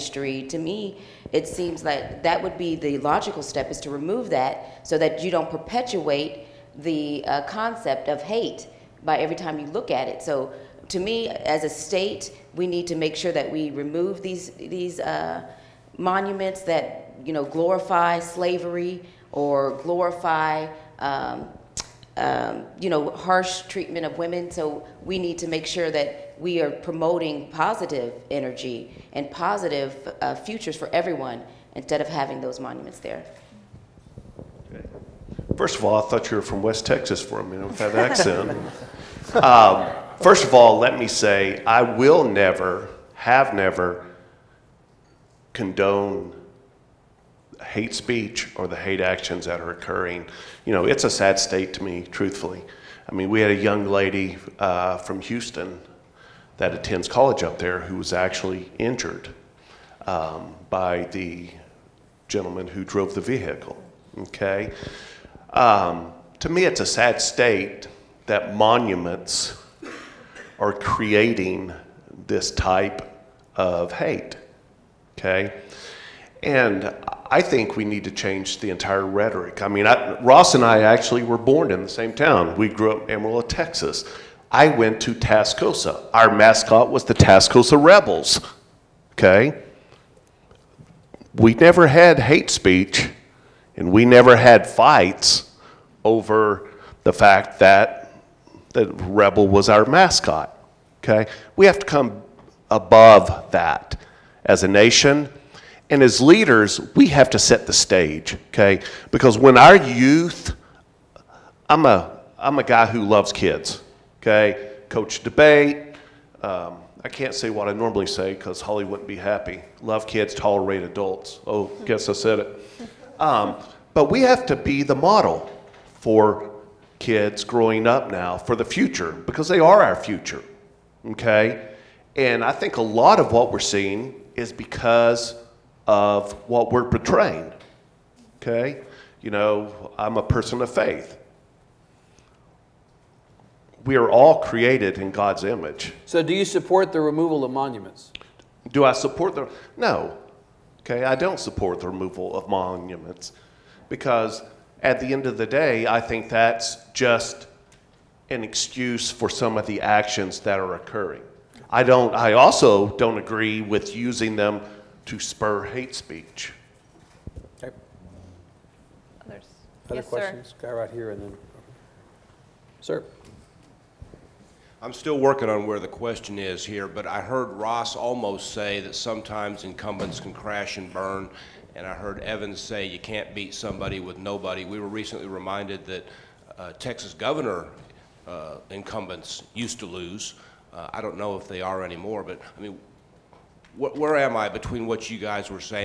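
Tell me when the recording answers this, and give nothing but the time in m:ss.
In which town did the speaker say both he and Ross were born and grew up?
1:23.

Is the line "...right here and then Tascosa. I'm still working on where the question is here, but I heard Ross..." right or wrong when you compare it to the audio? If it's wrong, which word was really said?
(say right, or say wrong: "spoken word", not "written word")
wrong: "Sir", not "Tascosa".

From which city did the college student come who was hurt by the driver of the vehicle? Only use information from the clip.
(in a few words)
Houston.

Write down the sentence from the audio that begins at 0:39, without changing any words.
um, first of all, let me say I will never, have never condone hate speech or the hate actions that are occurring.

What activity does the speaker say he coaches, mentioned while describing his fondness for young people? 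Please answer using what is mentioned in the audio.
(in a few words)
Debate.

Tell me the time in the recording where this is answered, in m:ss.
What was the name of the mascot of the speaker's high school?
1:27.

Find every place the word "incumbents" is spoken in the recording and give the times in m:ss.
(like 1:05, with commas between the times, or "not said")
2:59, 3:08.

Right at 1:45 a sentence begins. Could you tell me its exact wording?
And as leaders, we have to set the stage, okay?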